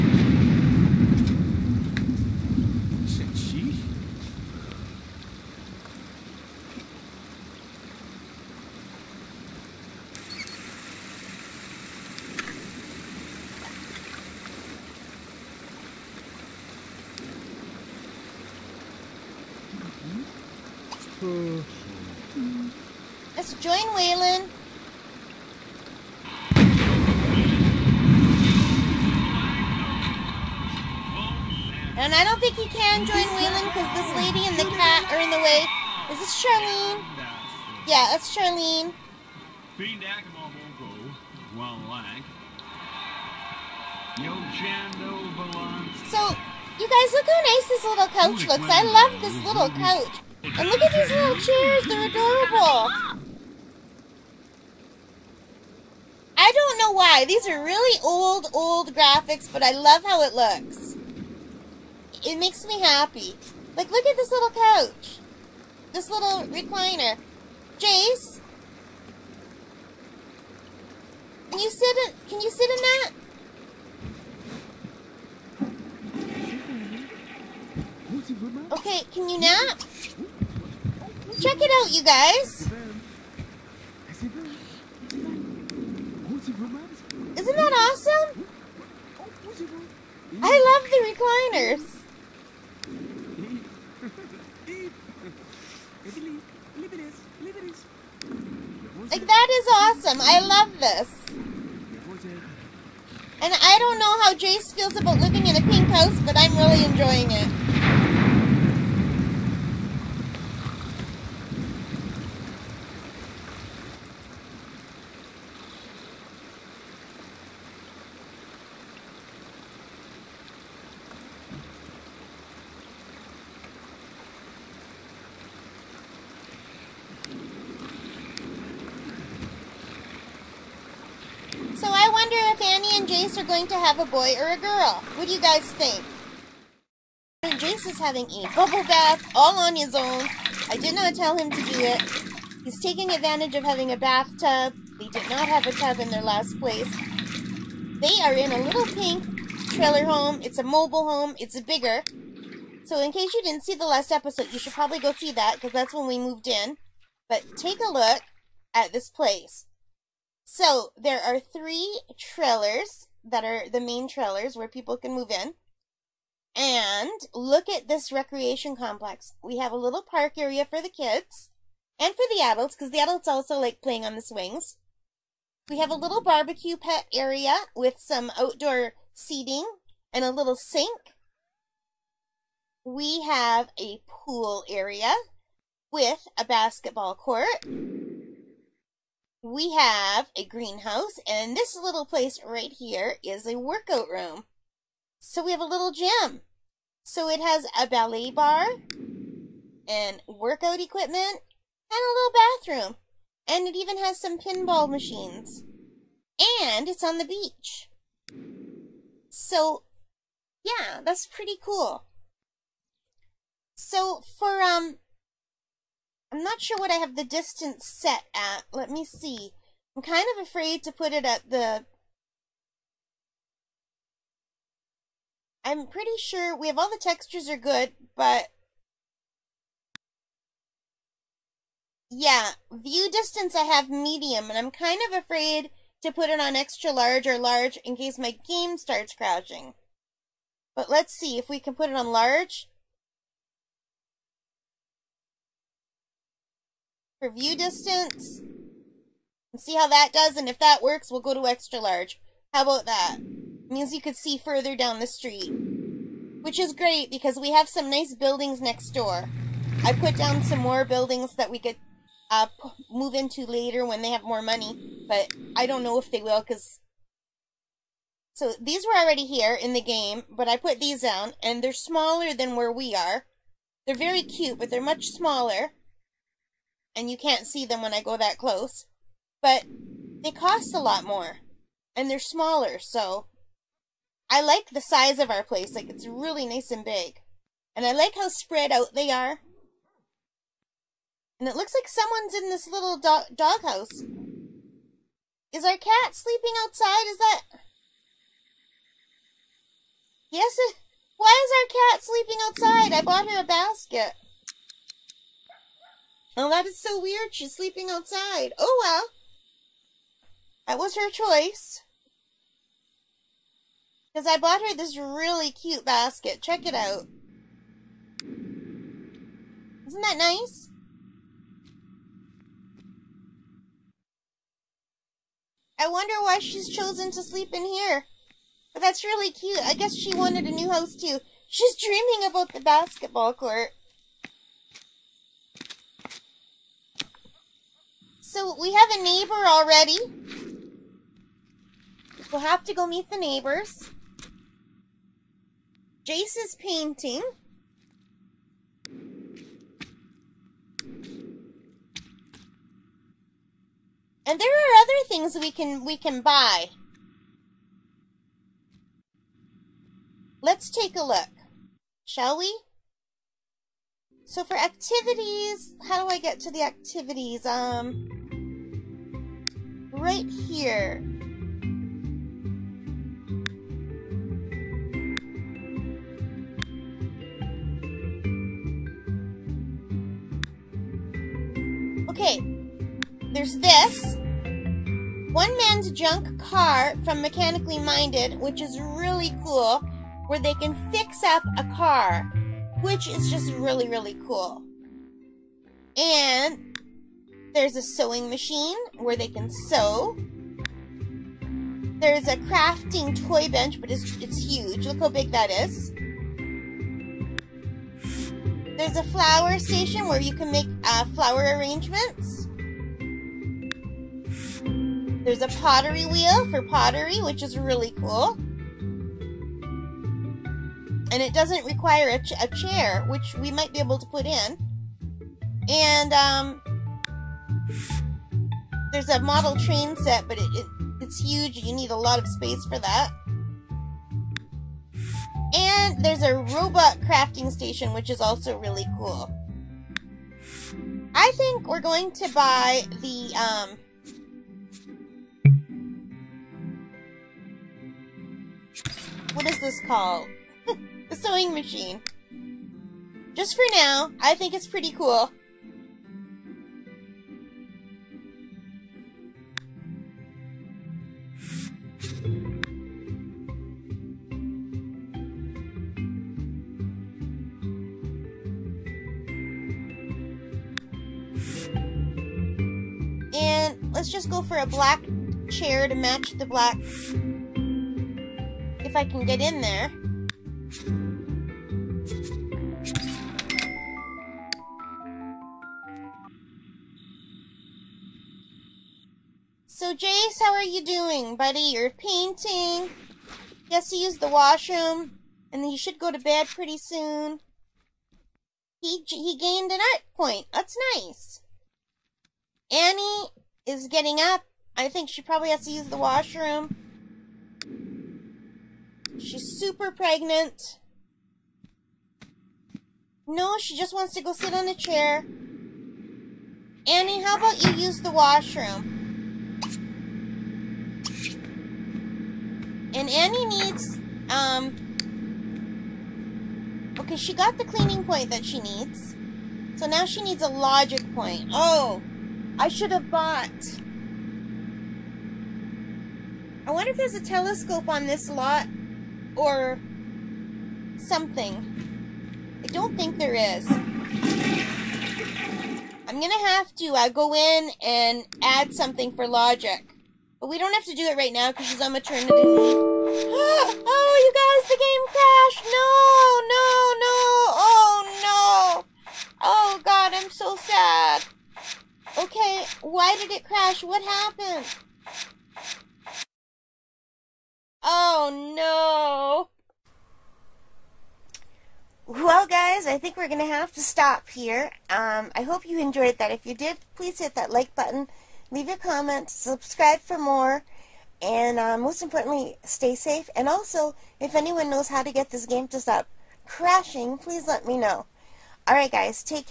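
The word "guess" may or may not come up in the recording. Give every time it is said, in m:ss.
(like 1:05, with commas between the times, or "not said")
5:29.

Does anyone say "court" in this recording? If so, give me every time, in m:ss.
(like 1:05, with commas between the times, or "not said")
3:07, 5:33.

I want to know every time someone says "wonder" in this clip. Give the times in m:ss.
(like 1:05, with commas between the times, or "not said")
5:25, 8:56.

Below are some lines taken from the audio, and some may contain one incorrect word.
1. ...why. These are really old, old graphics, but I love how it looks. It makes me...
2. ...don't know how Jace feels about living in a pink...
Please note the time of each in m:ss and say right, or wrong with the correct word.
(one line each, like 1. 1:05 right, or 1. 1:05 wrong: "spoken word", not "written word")
1. 0:56 right
2. 1:43 right.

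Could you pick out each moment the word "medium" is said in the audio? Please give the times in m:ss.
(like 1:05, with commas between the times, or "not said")
3:53.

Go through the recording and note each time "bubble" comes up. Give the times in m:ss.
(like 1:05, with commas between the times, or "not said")
2:18.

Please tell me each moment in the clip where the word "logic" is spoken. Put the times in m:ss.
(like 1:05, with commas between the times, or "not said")
8:50, 9:09.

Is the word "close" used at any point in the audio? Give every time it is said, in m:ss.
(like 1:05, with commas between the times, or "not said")
4:38.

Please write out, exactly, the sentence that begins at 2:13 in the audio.
Jace are going to have a boy or a girl.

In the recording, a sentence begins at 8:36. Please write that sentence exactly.
Annie, how about you use the washroom?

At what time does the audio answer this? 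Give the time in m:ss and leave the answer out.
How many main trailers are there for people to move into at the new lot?
2:41.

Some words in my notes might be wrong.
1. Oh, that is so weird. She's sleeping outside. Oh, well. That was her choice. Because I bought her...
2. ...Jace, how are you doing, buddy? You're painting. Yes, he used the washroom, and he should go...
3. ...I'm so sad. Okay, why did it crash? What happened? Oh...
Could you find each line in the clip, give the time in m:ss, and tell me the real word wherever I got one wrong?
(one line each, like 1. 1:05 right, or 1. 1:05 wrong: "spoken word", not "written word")
1. 5:06 right
2. 8:10 right
3. 9:20 right.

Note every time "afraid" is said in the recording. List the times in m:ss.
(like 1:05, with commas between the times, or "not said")
3:40, 3:55.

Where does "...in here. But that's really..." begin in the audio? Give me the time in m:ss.
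5:27.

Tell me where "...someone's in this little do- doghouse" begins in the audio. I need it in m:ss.
4:51.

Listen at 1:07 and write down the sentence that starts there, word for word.
Jace, can you sit in, can you sit in that?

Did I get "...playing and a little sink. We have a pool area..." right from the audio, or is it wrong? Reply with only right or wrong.
wrong.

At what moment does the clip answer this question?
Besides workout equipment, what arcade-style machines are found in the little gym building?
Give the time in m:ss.
3:24.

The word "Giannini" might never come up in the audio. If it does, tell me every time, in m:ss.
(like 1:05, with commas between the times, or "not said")
not said.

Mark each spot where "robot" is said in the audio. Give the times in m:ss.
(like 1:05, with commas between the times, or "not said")
7:16.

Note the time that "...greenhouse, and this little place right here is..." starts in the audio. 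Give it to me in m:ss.
3:10.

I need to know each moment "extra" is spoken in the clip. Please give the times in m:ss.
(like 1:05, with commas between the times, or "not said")
3:56, 4:11.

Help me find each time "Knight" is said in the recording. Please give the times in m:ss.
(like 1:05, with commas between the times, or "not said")
not said.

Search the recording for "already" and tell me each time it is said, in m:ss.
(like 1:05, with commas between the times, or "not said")
4:28, 5:39.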